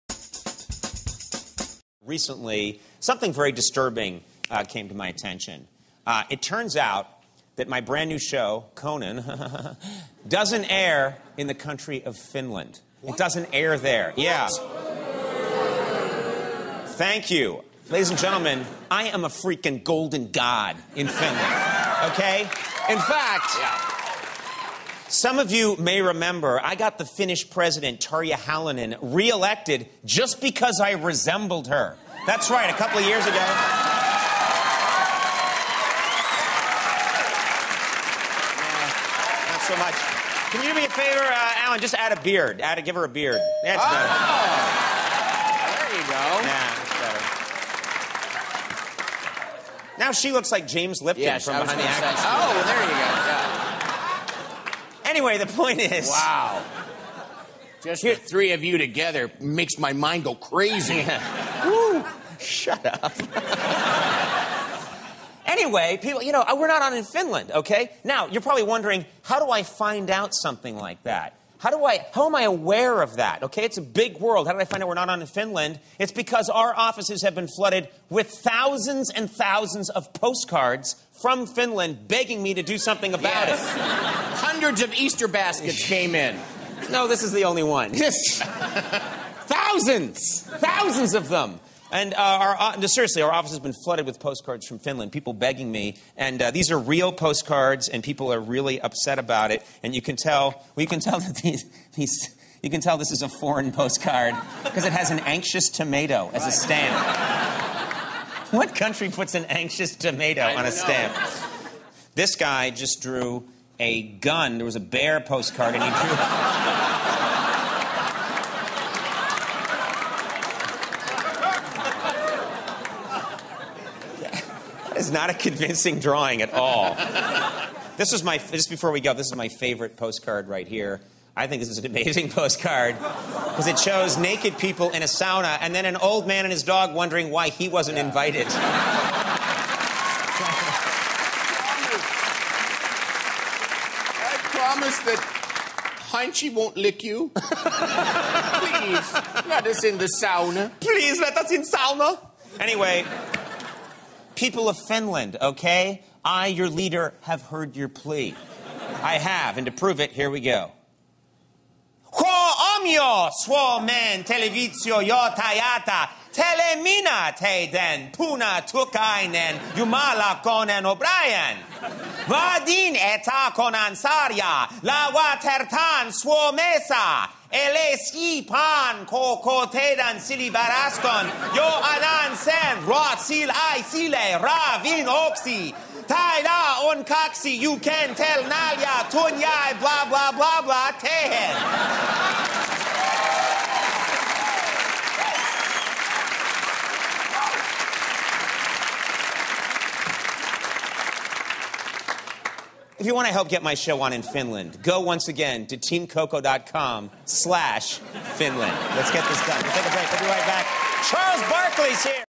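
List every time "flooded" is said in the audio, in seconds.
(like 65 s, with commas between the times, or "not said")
77 s, 93 s.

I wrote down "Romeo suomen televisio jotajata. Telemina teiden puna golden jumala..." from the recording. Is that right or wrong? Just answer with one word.
wrong.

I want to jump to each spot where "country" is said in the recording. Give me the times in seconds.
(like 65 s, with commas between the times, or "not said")
11 s, 108 s.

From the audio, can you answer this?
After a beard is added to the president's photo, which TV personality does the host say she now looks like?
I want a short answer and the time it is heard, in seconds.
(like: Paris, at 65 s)
James Lipton, at 50 s.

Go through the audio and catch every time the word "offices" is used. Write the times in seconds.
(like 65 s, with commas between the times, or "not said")
76 s, 93 s.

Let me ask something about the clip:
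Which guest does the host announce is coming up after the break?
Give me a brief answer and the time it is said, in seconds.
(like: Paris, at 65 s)
Charles Barkley, at 211 s.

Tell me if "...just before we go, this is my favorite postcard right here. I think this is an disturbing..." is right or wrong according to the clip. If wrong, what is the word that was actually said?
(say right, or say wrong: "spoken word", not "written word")
wrong: "amazing", not "disturbing".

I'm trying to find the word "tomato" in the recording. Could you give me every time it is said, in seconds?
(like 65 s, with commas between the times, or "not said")
105 s, 109 s.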